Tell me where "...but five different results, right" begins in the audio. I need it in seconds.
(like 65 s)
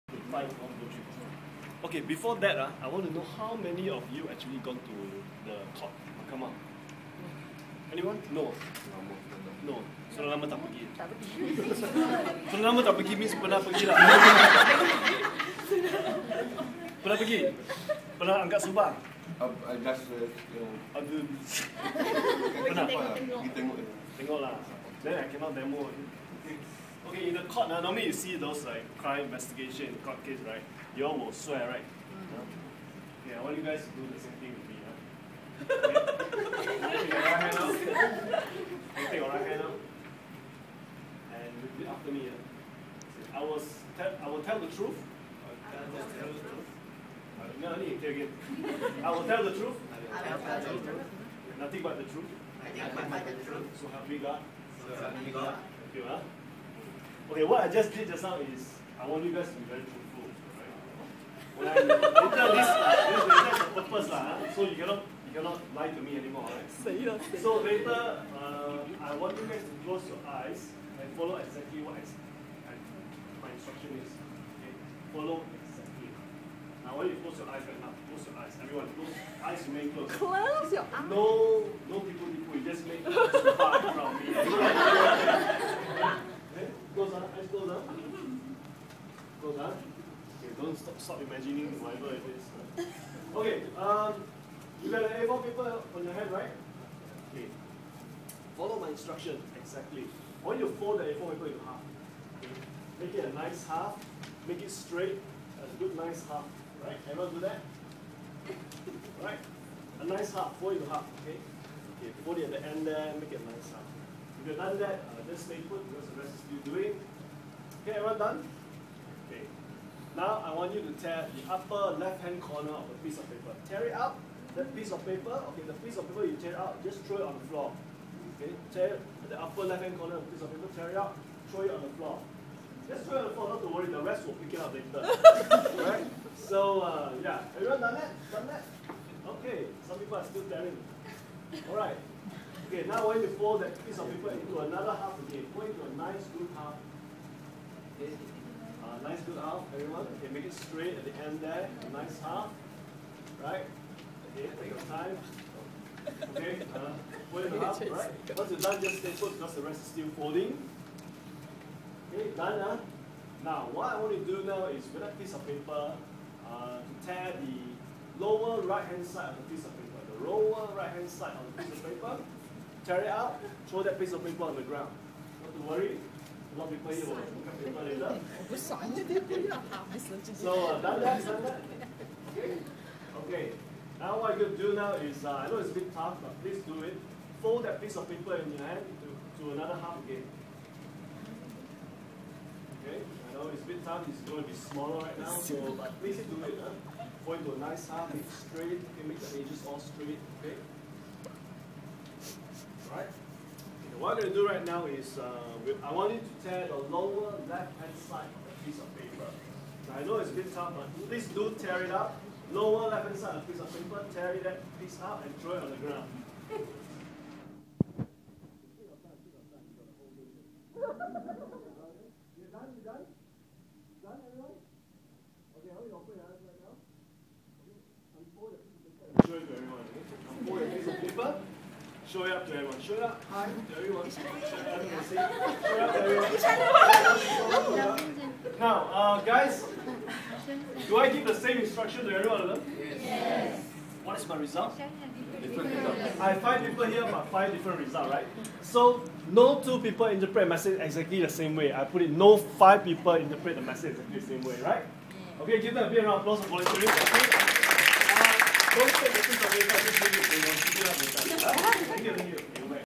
247 s.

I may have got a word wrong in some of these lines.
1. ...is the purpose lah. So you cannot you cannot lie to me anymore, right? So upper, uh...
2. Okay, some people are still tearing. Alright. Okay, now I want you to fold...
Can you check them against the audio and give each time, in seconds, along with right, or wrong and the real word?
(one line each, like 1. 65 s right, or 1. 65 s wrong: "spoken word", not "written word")
1. 63 s wrong: "later", not "upper"
2. 139 s right.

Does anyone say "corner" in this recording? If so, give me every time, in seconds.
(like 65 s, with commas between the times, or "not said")
122 s, 129 s.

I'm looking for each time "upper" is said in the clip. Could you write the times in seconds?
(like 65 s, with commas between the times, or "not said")
121 s, 129 s.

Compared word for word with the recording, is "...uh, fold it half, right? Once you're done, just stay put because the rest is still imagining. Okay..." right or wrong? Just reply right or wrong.
wrong.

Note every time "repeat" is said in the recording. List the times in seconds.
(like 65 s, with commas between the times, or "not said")
41 s.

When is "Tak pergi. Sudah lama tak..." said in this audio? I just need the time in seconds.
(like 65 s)
10 s.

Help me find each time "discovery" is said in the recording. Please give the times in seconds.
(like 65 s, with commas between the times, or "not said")
not said.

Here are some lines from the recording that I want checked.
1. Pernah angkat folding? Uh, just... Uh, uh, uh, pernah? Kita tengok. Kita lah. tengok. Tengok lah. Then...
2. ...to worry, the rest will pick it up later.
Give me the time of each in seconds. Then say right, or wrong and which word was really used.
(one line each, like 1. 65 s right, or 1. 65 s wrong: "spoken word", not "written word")
1. 18 s wrong: "subang", not "folding"
2. 133 s right.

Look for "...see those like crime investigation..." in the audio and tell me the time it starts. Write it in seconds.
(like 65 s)
28 s.